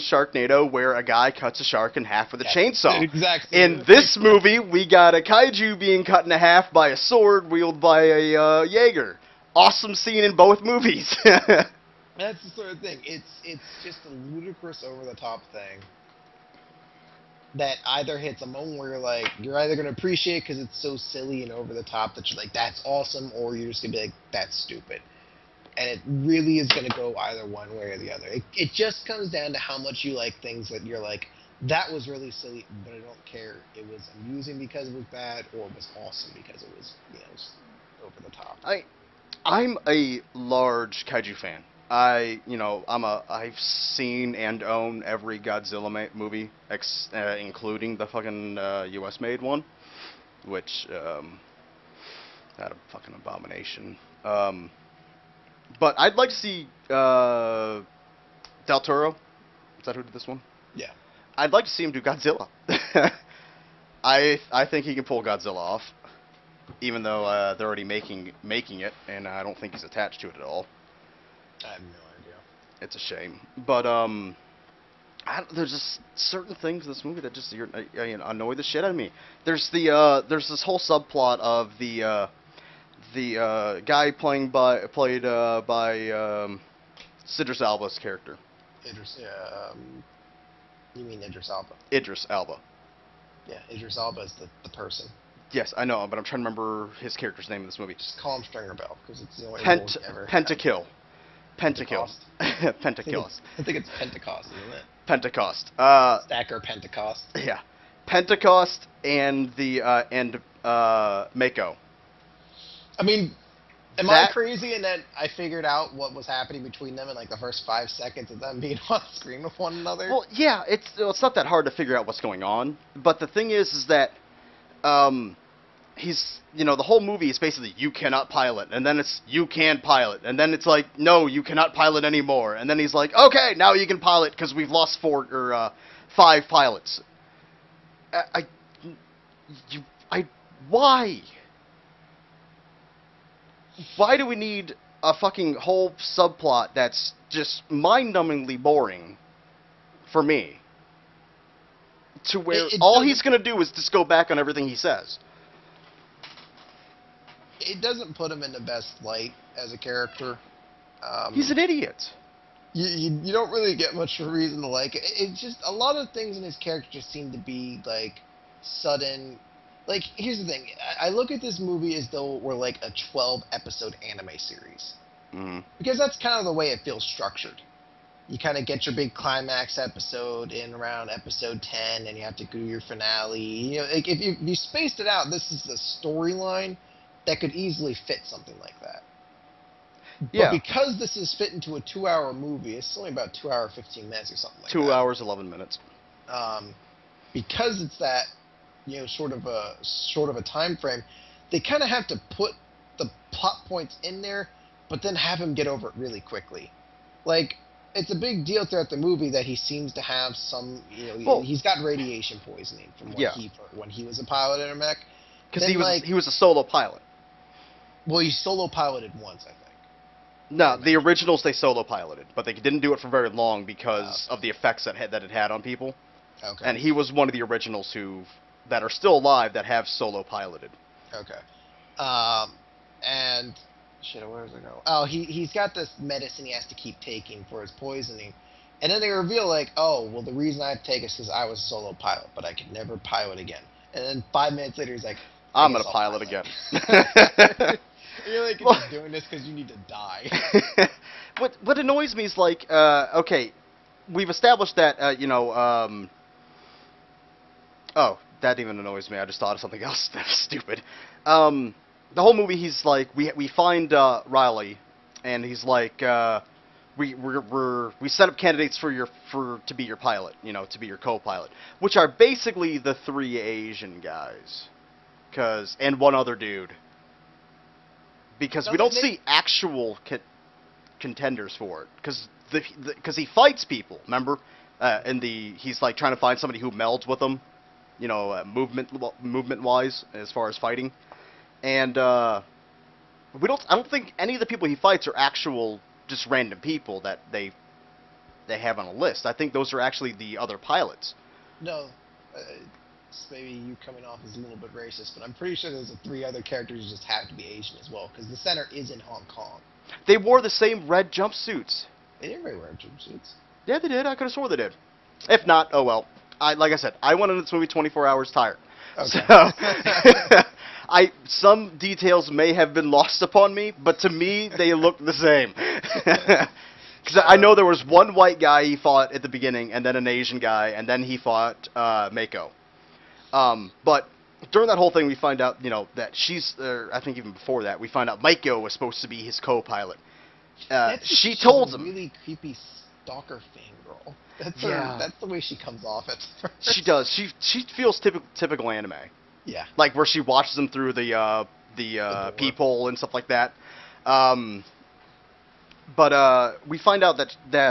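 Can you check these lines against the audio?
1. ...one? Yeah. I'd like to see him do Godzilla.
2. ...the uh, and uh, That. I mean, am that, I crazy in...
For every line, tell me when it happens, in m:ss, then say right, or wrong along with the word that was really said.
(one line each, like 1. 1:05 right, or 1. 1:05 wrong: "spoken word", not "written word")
1. 1:00 right
2. 1:49 wrong: "Mako", not "That".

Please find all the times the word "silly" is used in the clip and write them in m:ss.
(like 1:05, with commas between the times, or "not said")
0:20, 0:32.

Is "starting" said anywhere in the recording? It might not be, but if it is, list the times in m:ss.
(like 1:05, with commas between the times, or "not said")
not said.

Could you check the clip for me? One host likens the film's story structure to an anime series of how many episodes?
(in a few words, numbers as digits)
12.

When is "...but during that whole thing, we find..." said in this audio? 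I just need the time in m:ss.
5:33.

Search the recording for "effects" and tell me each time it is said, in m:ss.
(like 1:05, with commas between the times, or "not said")
3:44.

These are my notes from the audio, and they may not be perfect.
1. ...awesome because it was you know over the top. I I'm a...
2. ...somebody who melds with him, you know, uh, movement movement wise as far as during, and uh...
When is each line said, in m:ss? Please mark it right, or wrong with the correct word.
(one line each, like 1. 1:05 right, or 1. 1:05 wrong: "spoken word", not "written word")
1. 0:36 right
2. 4:46 wrong: "fighting", not "during".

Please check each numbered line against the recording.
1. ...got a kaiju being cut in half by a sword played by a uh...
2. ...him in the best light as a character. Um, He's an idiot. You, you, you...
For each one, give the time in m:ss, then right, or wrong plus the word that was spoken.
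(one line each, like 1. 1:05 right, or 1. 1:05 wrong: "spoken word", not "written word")
1. 0:04 wrong: "wielded", not "played"
2. 2:38 right.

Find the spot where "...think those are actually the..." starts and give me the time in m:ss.
4:59.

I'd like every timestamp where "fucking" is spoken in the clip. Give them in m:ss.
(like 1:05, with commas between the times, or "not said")
0:48, 0:52, 2:25.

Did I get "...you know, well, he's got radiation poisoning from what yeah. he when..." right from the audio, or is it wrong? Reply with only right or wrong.
right.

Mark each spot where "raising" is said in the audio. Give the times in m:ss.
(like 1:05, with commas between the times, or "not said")
not said.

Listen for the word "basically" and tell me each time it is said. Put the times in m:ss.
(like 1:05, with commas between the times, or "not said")
2:07, 4:32.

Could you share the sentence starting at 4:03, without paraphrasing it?
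And then five minutes later, he's like, I'm gonna pilot again.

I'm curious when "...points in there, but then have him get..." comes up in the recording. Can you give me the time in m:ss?
3:23.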